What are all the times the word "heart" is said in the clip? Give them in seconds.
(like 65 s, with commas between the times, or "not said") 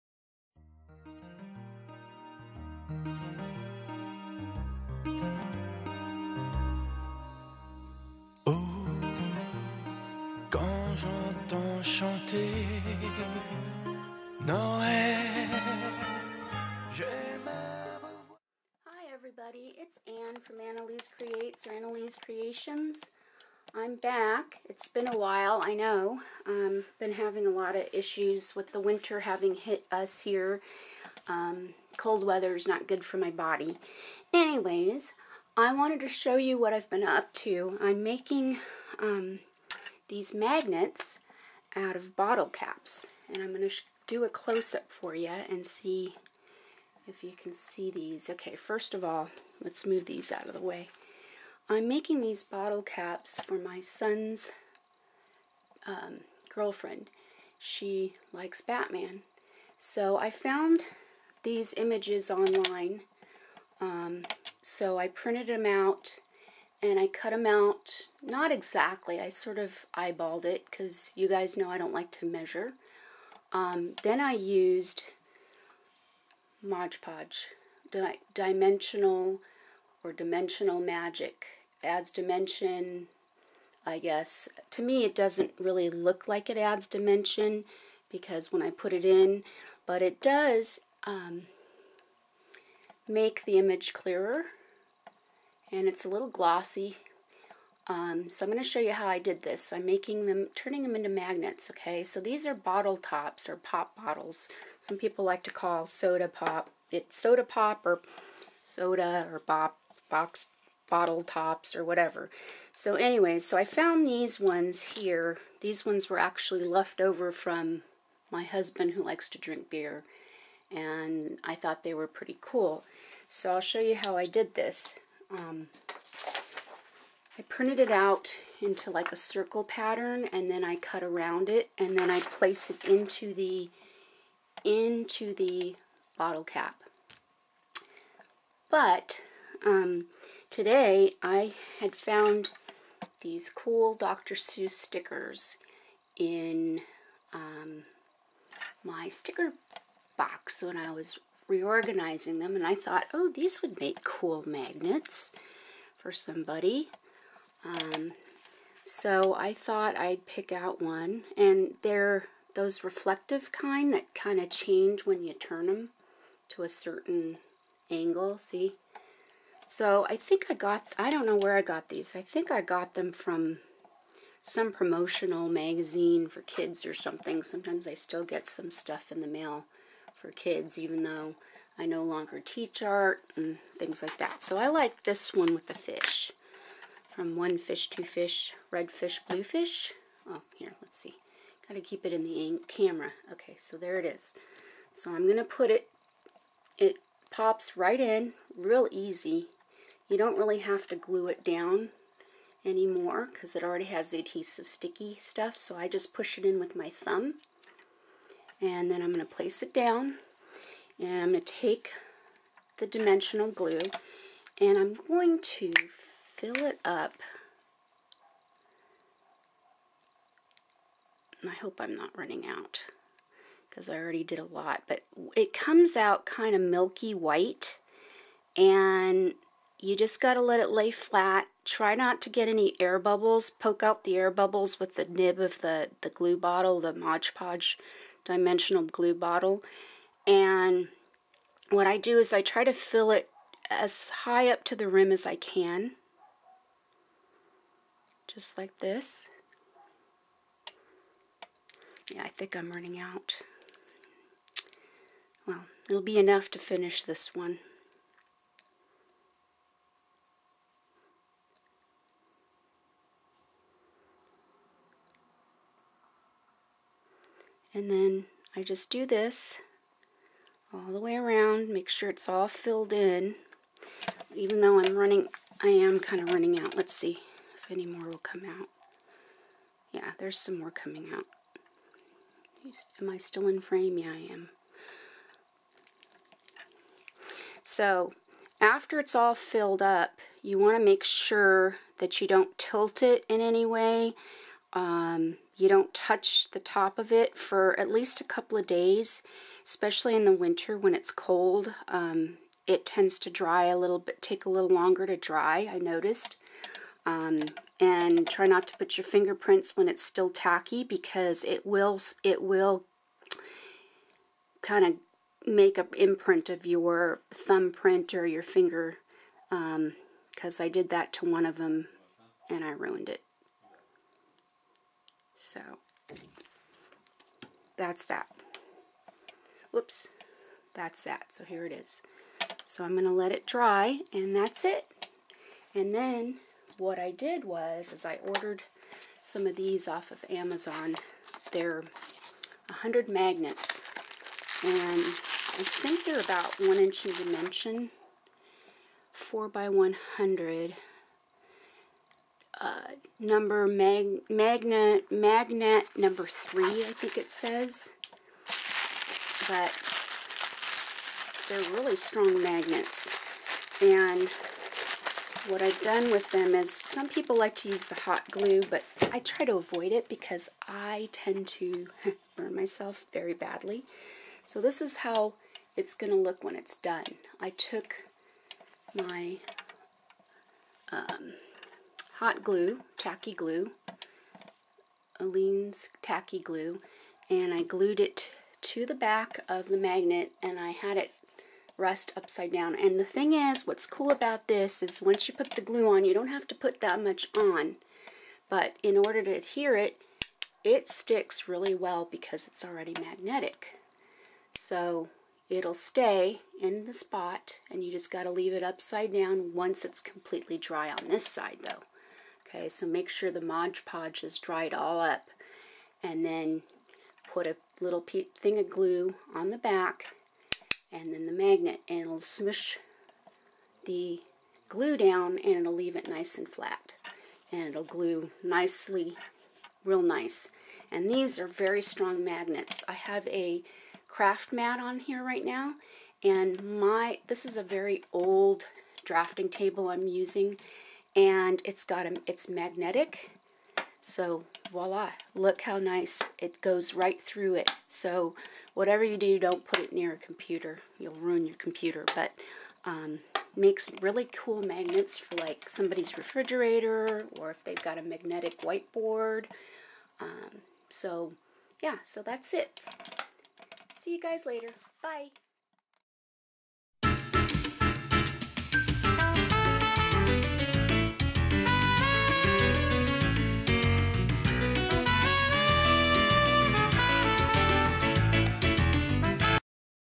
not said.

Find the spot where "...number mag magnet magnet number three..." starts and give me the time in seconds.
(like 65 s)
353 s.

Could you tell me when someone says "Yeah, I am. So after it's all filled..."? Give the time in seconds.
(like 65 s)
283 s.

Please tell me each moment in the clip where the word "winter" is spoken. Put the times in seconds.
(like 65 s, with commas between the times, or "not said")
28 s, 300 s.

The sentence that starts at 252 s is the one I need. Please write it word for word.
Yeah, I think I'm running out.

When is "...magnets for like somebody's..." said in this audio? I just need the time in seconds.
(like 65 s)
454 s.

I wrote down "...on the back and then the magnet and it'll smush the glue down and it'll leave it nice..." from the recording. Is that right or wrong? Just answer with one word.
right.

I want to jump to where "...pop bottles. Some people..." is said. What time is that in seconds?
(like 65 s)
103 s.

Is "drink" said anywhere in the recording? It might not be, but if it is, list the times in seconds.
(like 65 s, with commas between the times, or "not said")
119 s.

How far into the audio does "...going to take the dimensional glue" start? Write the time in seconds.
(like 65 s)
211 s.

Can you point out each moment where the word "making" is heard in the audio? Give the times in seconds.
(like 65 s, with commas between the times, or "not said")
38 s, 51 s, 99 s.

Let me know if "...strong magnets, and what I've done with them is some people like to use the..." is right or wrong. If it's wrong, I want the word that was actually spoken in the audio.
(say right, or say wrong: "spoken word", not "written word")
right.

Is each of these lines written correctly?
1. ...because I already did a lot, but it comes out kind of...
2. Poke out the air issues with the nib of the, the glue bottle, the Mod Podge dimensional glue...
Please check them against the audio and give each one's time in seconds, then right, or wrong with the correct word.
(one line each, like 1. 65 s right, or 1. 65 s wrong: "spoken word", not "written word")
1. 223 s right
2. 233 s wrong: "bubbles", not "issues".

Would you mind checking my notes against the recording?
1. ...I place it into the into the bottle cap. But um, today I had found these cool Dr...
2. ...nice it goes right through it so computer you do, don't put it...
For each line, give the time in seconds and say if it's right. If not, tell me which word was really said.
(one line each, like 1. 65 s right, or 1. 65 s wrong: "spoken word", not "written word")
1. 132 s right
2. 445 s wrong: "whatever", not "computer".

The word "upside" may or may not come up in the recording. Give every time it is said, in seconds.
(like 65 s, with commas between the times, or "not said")
392 s, 408 s.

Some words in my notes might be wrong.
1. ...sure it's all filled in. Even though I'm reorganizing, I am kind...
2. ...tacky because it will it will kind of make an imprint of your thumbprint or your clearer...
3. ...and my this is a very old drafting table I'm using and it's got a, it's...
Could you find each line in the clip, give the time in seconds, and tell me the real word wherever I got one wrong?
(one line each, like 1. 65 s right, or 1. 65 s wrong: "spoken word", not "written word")
1. 271 s wrong: "running", not "reorganizing"
2. 310 s wrong: "finger", not "clearer"
3. 436 s right.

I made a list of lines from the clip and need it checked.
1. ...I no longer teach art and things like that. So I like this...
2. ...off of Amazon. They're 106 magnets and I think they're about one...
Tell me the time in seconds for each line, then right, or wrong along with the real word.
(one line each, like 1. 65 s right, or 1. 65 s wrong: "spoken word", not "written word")
1. 181 s right
2. 339 s wrong: "100", not "106".